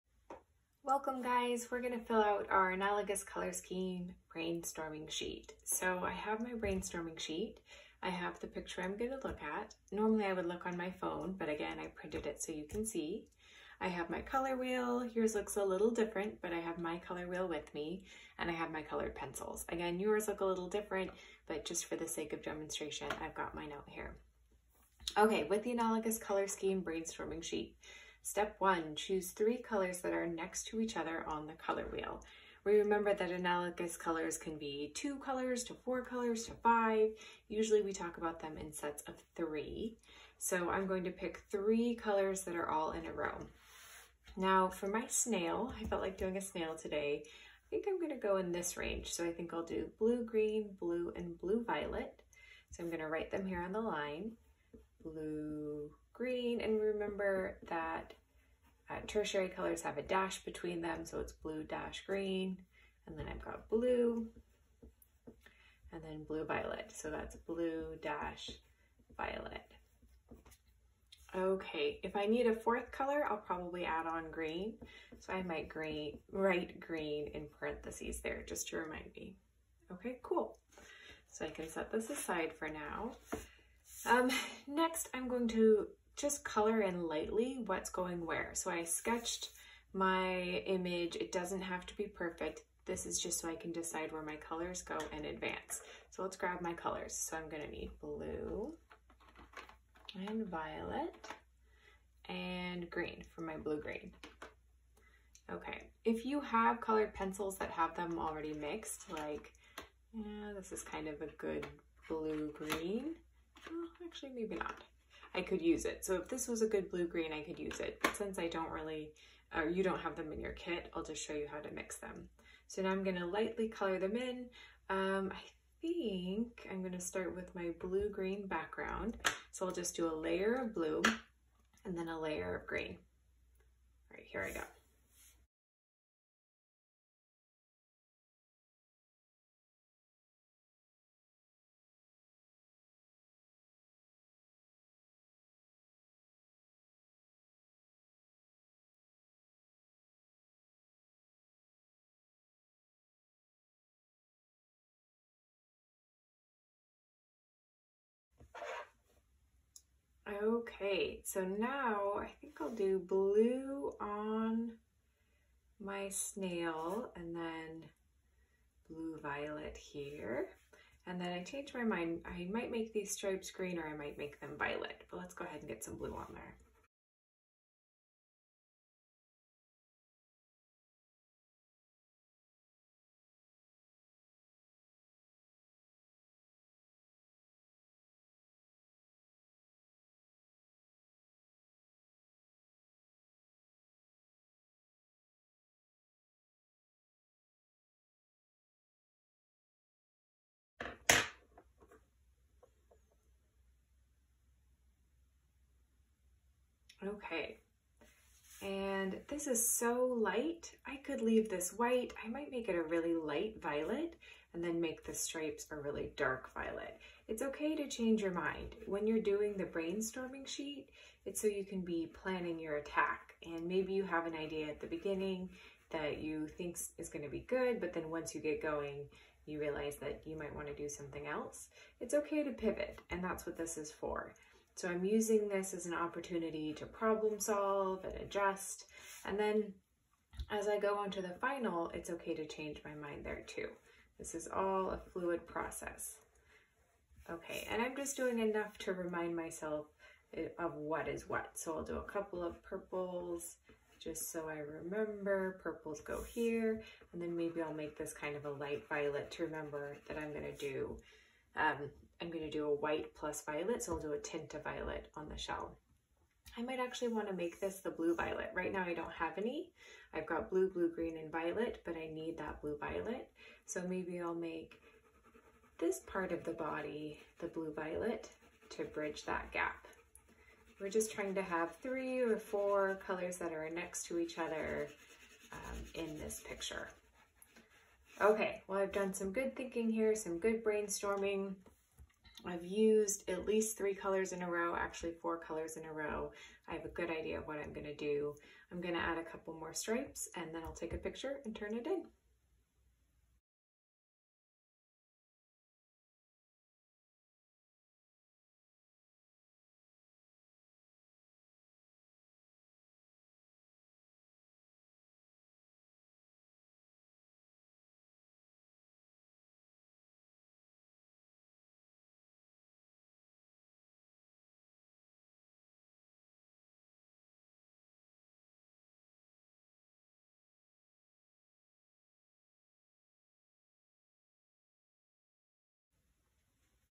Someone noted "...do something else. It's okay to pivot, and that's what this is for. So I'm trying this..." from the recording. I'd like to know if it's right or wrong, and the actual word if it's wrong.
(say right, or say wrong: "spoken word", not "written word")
wrong: "using", not "trying".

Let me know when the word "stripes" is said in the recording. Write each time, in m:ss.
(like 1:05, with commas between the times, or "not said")
2:53, 3:35, 4:59.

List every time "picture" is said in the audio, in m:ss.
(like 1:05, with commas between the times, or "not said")
0:08, 4:46, 5:00.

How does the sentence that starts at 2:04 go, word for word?
Um, I think I'm gonna start with my blue-green background.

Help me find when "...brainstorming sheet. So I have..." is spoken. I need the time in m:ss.
0:04.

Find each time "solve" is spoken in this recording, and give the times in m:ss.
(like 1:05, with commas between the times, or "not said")
3:57.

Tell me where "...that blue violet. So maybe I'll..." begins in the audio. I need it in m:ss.
4:32.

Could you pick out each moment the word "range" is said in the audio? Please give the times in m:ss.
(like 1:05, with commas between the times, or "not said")
0:48.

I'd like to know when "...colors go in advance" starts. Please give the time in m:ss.
1:34.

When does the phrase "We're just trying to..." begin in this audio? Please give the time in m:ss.
4:40.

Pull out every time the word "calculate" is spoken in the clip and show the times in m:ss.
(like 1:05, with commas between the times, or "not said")
not said.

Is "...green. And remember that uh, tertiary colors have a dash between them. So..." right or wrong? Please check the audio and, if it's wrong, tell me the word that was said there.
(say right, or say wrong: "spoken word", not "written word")
right.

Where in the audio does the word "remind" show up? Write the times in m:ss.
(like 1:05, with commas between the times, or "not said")
1:18, 4:08.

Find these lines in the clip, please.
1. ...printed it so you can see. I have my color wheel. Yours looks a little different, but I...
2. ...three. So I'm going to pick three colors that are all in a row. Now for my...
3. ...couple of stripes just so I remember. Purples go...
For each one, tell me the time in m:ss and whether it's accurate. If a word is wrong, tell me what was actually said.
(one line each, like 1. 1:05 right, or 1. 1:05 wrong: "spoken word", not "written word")
1. 0:11 right
2. 0:39 right
3. 4:12 wrong: "purples", not "stripes".